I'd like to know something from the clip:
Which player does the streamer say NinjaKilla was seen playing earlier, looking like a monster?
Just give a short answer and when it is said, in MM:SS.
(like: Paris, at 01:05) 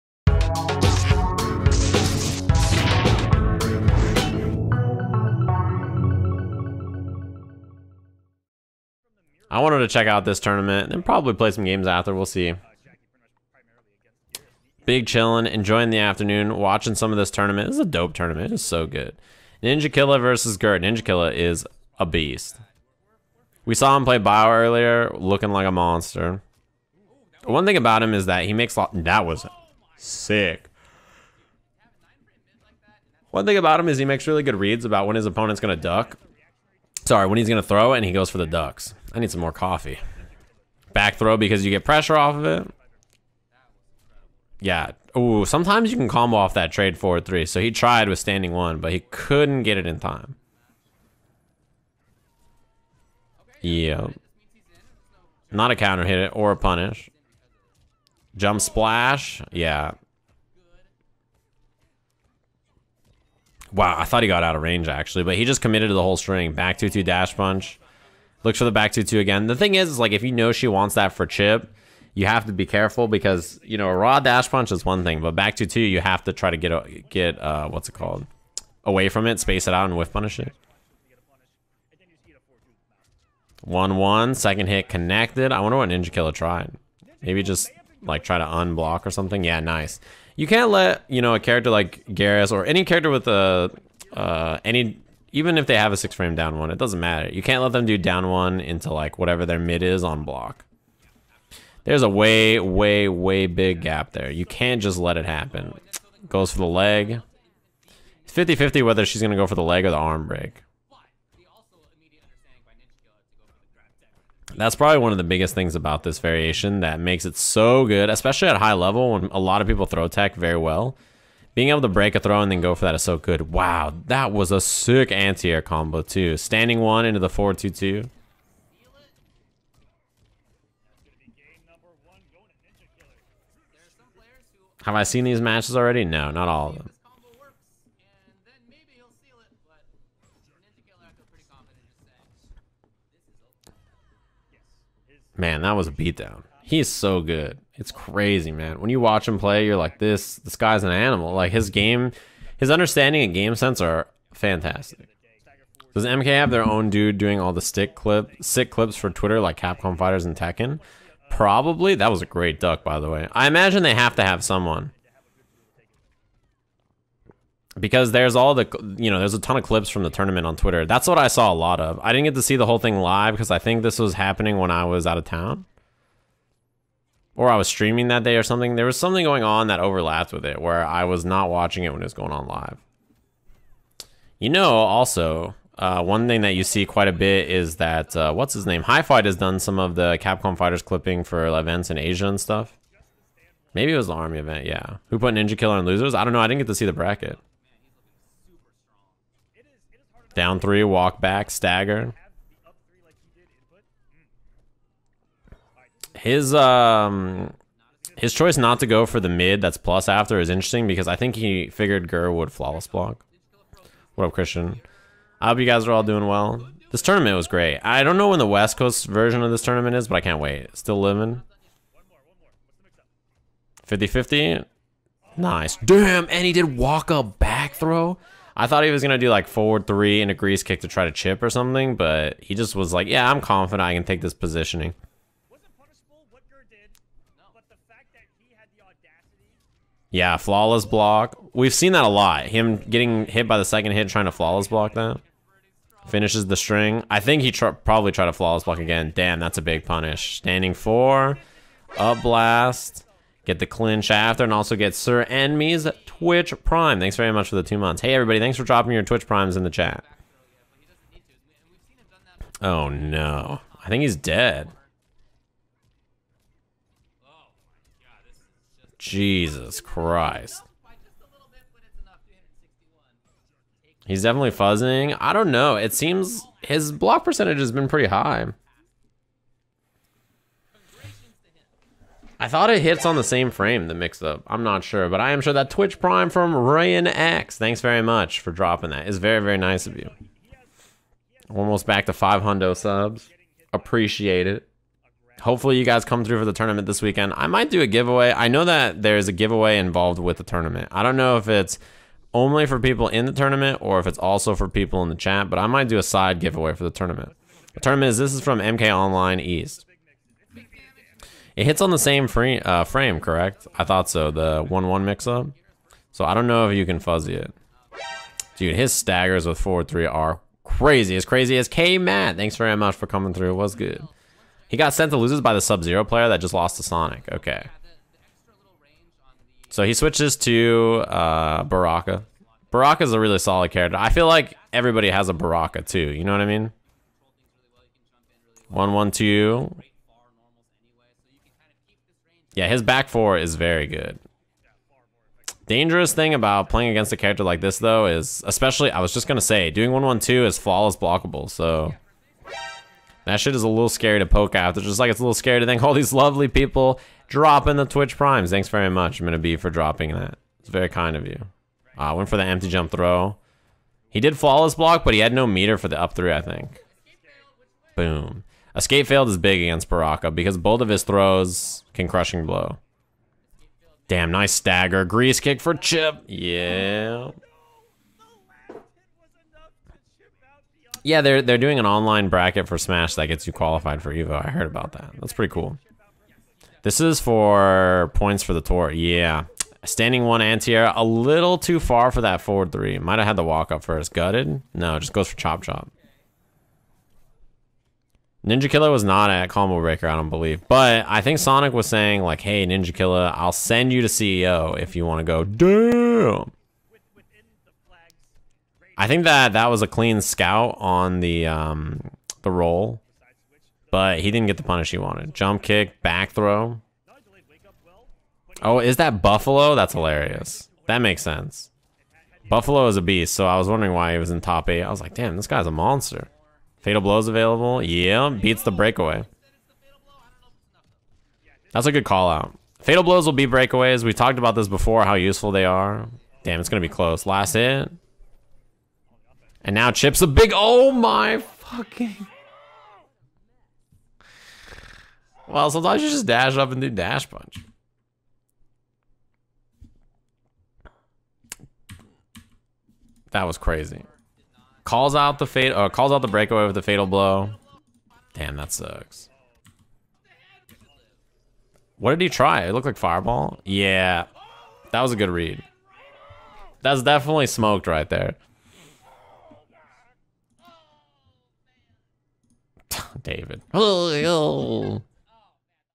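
Bio, at 00:24.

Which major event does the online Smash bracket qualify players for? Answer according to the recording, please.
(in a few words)
Evo.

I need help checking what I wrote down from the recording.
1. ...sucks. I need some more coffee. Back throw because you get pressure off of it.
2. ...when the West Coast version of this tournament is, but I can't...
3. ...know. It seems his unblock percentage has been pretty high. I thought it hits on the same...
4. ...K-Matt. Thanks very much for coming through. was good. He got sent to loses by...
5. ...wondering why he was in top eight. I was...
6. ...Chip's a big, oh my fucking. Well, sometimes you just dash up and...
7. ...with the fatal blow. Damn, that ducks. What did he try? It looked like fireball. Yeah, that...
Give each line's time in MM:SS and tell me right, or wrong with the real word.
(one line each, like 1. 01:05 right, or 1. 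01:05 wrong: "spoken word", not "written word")
1. 00:38 wrong: "ducks", not "sucks"
2. 03:38 right
3. 04:35 wrong: "block", not "unblock"
4. 05:21 right
5. 07:03 right
6. 07:19 right
7. 07:36 wrong: "sucks", not "ducks".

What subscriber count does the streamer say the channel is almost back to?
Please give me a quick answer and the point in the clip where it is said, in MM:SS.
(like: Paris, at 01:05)
500, at 04:52.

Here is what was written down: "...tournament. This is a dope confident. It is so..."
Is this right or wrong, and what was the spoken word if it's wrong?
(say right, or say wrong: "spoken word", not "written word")
wrong: "tournament", not "confident".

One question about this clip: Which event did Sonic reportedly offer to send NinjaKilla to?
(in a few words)
CEO.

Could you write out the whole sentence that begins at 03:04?
You know, also, uh, one thing that you see quite a bit is that, uh, what's his name?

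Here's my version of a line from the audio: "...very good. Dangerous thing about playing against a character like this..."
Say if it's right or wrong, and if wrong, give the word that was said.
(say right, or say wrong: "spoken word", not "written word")
right.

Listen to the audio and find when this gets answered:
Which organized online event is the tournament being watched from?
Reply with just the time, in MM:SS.
05:08.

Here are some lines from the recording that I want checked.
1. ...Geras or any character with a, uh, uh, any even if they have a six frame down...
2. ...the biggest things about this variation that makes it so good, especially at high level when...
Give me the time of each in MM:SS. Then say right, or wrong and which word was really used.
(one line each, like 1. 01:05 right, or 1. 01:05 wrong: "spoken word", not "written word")
1. 01:32 right
2. 01:55 right.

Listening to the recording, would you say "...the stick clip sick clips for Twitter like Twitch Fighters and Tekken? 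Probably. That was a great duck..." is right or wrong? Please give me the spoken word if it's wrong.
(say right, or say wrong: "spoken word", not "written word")
wrong: "Capcom", not "Twitch".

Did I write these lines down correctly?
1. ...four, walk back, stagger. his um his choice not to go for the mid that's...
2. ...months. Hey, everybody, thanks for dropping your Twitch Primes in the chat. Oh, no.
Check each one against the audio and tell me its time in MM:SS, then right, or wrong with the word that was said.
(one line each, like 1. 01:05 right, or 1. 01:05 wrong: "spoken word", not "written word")
1. 03:20 wrong: "three", not "four"
2. 04:17 right.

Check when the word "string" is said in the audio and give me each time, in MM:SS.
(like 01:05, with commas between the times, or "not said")
01:06, 04:06.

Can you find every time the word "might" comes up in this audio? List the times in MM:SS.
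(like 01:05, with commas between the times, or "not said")
04:57, 05:05, 06:32.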